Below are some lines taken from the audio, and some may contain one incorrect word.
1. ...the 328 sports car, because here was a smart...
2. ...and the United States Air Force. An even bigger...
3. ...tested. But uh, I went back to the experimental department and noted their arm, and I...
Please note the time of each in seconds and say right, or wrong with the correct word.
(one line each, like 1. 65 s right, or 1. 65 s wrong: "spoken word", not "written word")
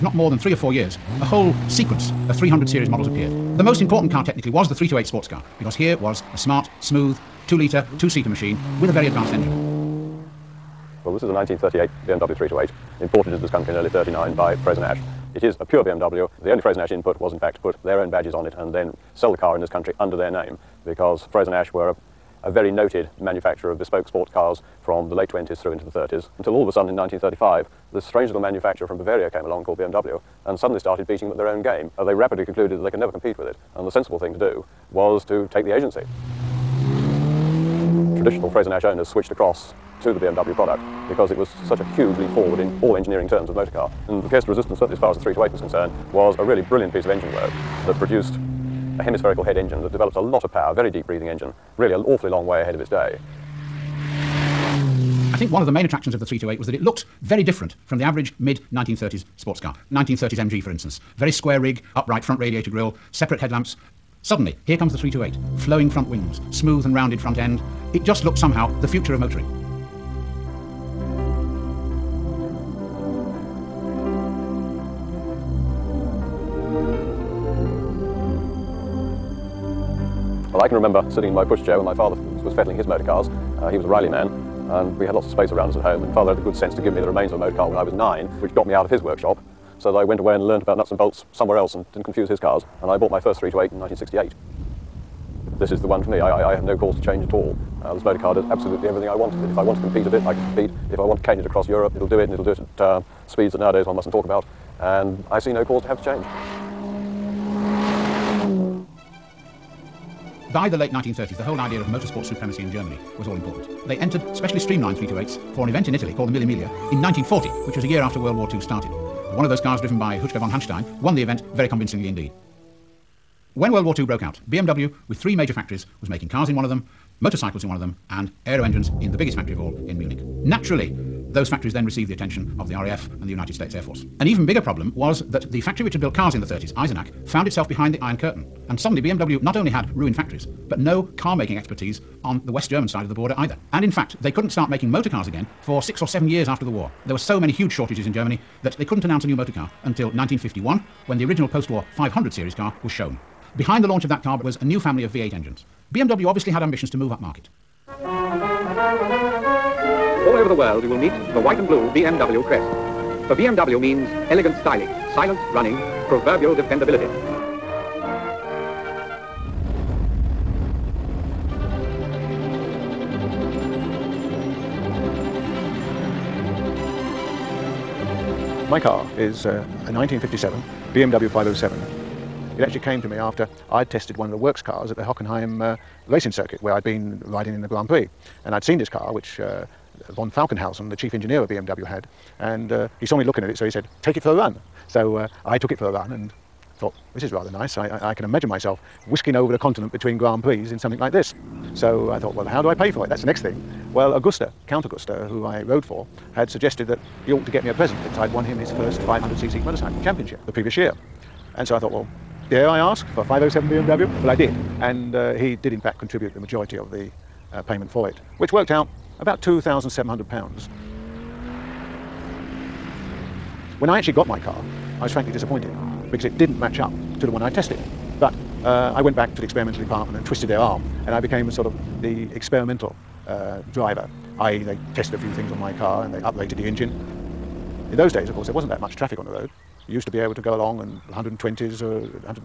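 1. 4 s right
2. 133 s right
3. 227 s wrong: "twisted", not "noted".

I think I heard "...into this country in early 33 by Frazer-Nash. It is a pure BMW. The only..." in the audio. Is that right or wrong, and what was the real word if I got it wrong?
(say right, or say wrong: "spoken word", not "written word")
wrong: "39", not "33".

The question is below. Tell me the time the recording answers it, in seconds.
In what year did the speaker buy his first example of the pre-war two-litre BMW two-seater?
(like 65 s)
93 s.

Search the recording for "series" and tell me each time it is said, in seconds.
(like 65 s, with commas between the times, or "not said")
2 s, 152 s.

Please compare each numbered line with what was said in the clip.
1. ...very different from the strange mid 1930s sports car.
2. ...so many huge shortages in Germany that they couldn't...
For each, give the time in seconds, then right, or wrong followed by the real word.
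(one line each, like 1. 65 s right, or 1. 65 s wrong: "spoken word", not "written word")
1. 57 s wrong: "average", not "strange"
2. 147 s right.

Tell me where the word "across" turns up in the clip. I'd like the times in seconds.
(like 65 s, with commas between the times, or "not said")
39 s, 101 s.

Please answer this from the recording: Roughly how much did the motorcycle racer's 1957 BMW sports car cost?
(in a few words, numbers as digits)
£2,700.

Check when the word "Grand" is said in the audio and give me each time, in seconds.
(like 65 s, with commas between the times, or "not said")
187 s, 200 s.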